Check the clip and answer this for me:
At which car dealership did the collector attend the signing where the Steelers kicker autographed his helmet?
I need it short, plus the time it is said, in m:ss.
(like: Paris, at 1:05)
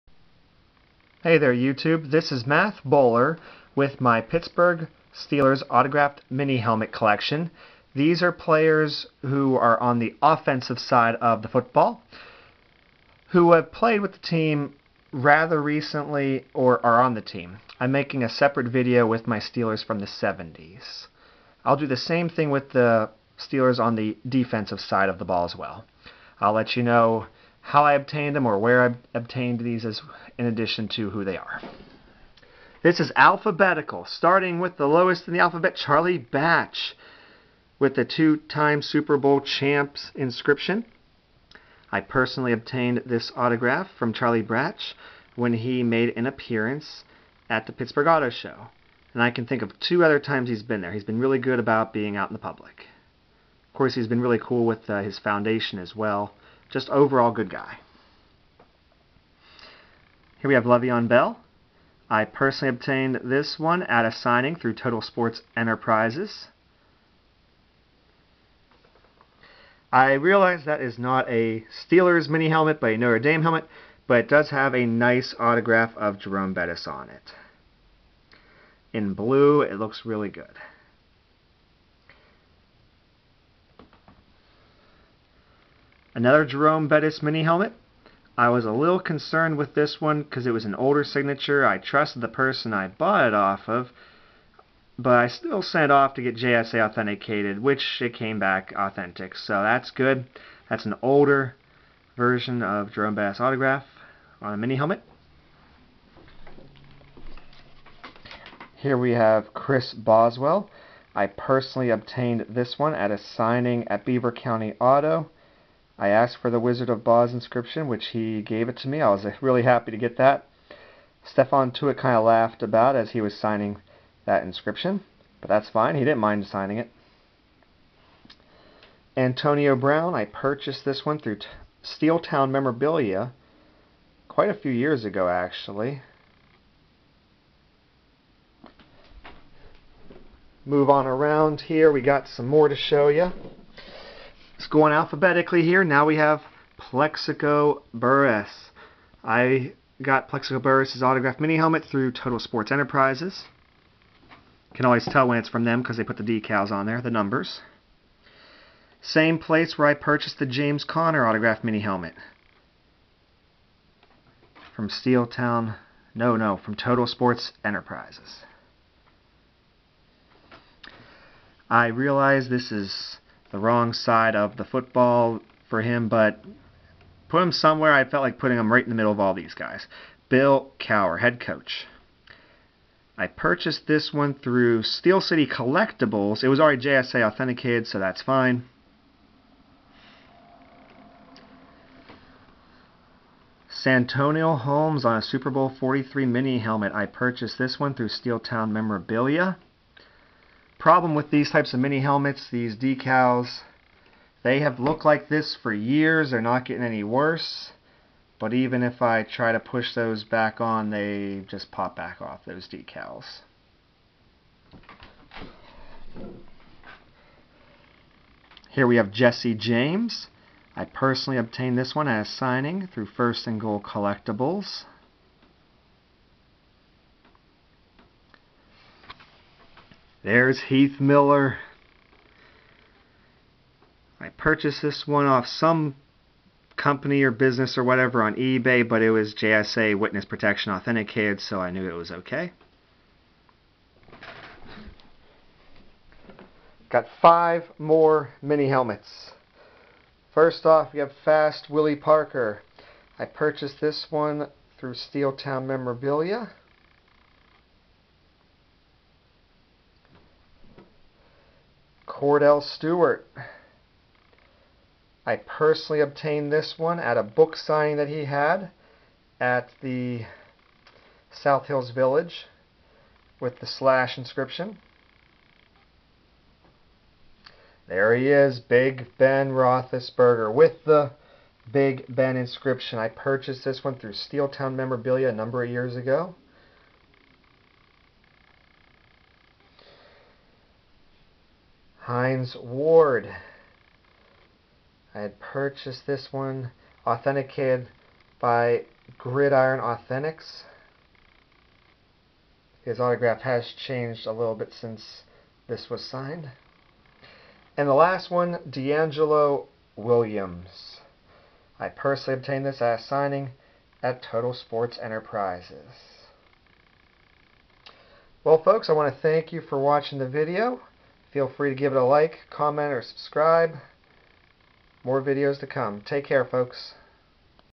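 Beaver County Auto, at 1:54.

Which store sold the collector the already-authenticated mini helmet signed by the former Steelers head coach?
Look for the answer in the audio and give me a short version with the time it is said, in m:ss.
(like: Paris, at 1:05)
Steel City Collectibles, at 3:04.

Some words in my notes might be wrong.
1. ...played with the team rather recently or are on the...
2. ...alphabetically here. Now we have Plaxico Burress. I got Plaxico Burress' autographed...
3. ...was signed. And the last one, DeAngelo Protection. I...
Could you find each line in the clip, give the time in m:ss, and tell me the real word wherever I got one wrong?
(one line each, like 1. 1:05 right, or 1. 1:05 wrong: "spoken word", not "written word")
1. 0:13 right
2. 2:24 right
3. 5:05 wrong: "Williams", not "Protection".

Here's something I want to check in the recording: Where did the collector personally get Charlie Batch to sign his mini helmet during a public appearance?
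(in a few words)
Pittsburgh Auto Show.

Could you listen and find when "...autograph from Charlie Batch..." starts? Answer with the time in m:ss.
0:43.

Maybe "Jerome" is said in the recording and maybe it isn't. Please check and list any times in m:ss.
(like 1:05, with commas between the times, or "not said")
1:16, 1:26, 1:42.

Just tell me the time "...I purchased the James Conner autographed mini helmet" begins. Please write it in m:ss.
2:39.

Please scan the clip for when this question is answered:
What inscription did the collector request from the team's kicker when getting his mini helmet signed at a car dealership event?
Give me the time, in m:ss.
1:56.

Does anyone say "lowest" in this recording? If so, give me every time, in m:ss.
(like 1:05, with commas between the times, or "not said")
0:34.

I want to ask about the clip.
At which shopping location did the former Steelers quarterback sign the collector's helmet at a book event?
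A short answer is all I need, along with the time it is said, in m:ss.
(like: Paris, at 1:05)
South Hills Village, at 4:31.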